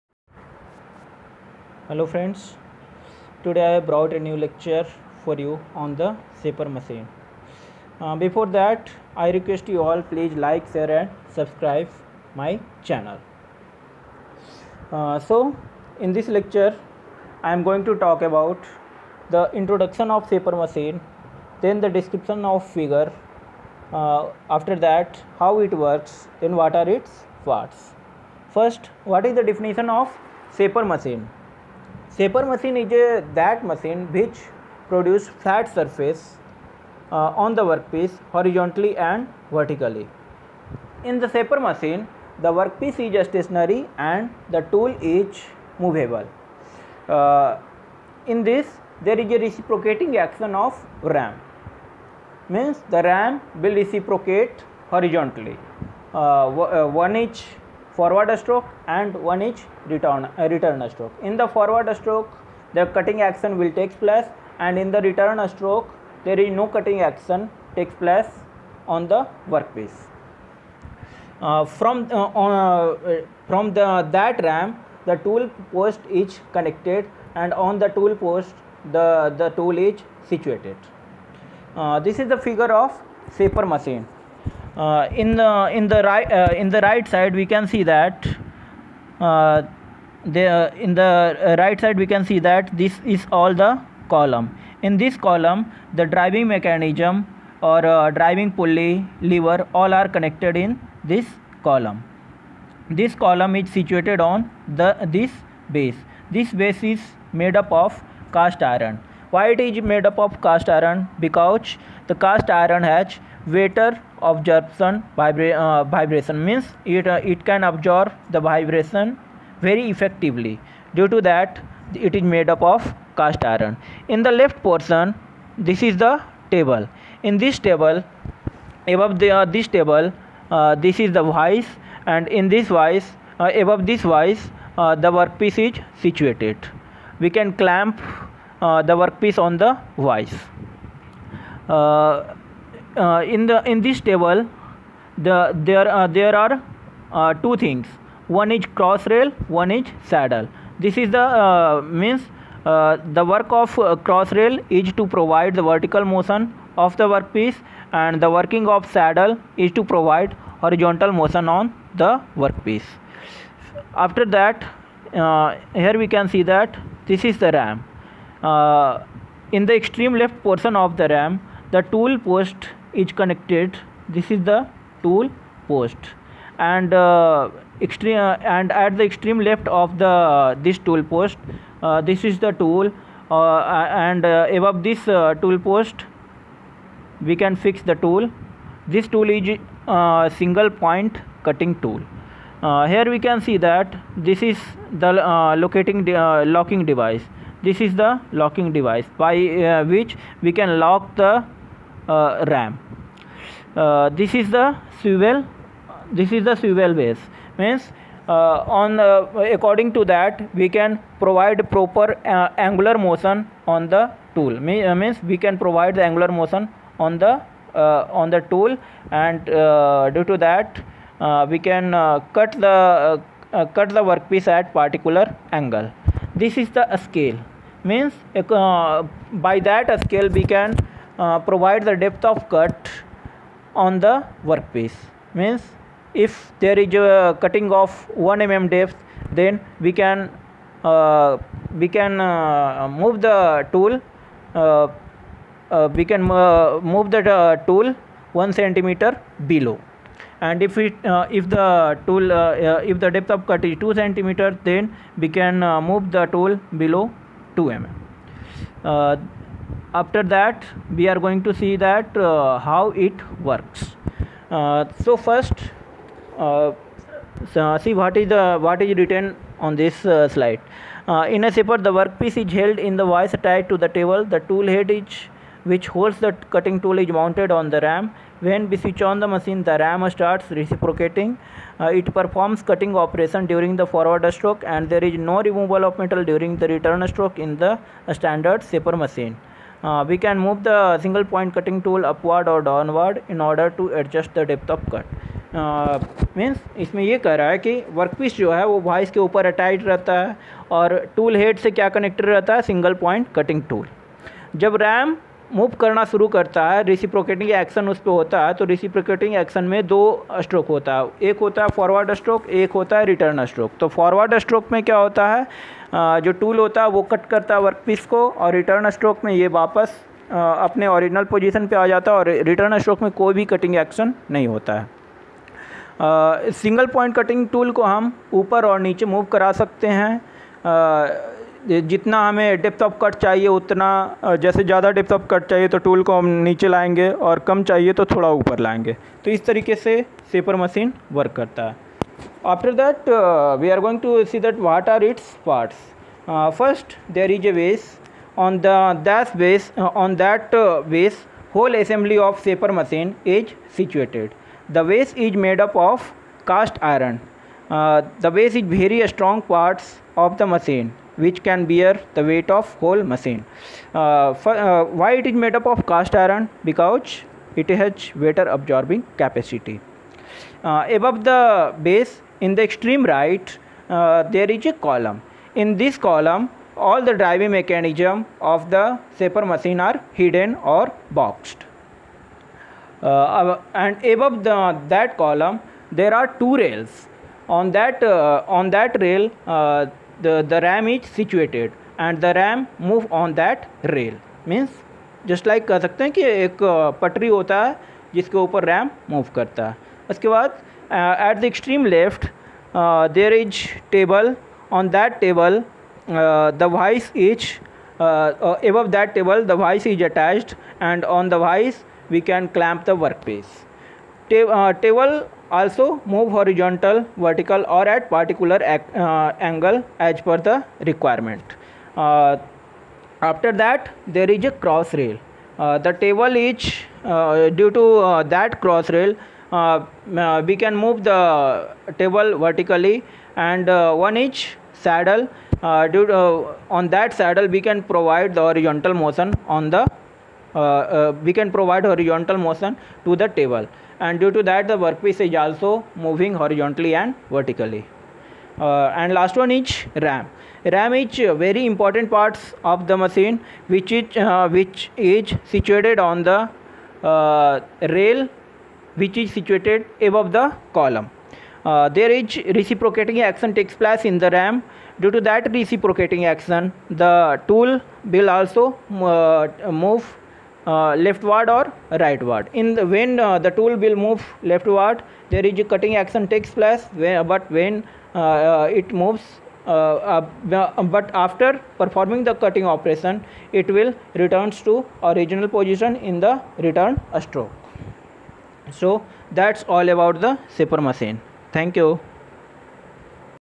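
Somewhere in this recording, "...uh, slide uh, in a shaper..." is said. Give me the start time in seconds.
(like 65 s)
270 s.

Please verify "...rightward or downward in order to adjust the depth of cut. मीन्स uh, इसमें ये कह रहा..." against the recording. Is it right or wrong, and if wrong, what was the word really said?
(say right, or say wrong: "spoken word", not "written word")
wrong: "upward", not "rightward".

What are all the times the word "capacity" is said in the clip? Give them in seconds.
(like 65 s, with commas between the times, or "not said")
369 s.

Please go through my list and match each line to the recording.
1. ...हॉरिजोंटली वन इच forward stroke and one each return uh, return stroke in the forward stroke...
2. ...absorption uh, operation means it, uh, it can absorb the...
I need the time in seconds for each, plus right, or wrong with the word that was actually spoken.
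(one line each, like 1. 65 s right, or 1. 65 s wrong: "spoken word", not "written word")
1. 54 s right
2. 114 s wrong: "vibration", not "operation".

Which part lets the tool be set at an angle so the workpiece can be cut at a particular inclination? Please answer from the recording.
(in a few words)
swivel base.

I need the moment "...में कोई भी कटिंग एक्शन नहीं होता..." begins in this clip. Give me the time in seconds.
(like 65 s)
323 s.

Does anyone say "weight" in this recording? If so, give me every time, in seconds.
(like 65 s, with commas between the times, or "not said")
362 s.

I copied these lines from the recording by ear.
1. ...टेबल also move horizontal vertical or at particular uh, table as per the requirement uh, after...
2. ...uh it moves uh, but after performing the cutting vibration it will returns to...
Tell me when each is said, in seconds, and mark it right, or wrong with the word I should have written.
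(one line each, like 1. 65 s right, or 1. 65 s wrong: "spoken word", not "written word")
1. 414 s wrong: "angle", not "table"
2. 478 s wrong: "operation", not "vibration".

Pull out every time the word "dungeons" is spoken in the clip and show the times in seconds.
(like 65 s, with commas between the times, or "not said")
not said.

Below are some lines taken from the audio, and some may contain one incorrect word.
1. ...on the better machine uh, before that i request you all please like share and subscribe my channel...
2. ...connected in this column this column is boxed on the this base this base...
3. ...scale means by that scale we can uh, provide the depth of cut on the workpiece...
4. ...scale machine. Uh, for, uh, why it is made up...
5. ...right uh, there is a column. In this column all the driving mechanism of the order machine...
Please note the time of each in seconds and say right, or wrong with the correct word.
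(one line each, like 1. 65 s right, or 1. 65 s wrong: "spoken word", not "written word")
1. 5 s wrong: "shaper", not "better"
2. 100 s wrong: "situated", not "boxed"
3. 227 s right
4. 362 s wrong: "whole", not "scale"
5. 373 s wrong: "shaper", not "order".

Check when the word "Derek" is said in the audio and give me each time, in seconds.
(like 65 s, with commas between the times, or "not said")
not said.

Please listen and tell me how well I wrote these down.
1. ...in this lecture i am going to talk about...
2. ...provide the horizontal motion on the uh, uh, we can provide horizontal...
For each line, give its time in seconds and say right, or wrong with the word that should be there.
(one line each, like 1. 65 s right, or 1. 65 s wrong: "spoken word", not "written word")
1. 15 s right
2. 437 s right.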